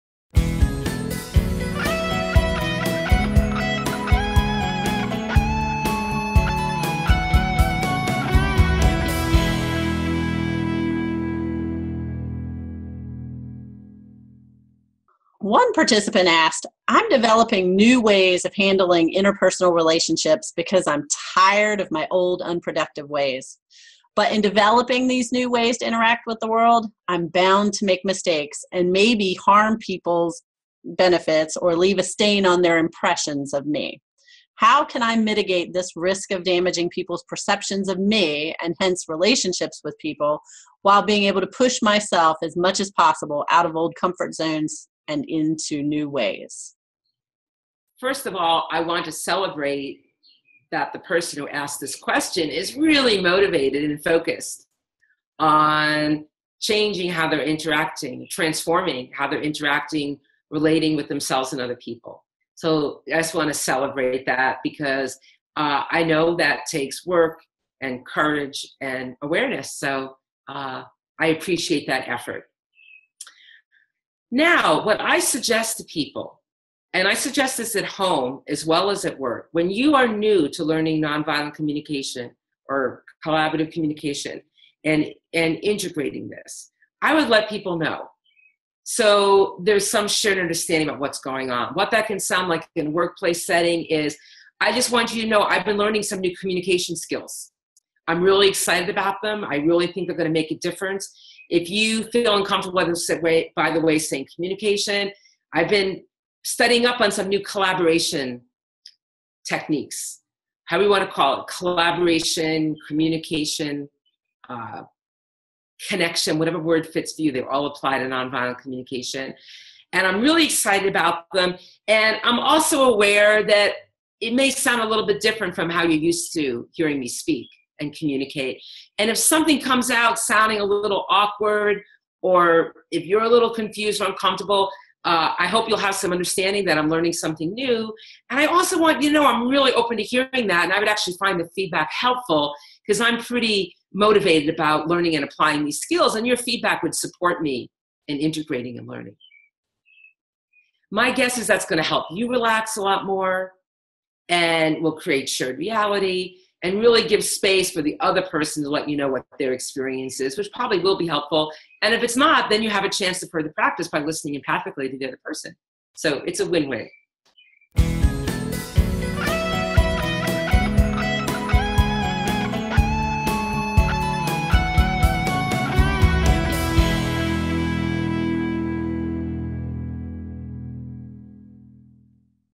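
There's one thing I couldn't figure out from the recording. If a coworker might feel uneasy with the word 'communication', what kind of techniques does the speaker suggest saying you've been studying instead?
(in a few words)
collaboration techniques.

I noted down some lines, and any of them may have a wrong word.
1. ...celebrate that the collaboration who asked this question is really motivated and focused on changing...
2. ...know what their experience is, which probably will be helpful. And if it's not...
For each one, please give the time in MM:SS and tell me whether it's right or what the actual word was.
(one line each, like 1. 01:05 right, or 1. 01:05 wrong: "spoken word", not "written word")
1. 00:49 wrong: "person", not "collaboration"
2. 02:38 right.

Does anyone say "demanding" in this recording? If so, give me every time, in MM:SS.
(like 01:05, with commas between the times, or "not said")
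not said.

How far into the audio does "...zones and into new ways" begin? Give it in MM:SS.
00:44.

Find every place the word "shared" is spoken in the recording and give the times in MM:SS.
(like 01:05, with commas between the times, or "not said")
01:30, 02:35.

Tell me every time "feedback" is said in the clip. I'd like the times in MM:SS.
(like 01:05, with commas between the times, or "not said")
02:21, 02:26.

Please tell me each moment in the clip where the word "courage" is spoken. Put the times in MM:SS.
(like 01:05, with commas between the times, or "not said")
01:08.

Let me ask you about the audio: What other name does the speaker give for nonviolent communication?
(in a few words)
collaborative communication.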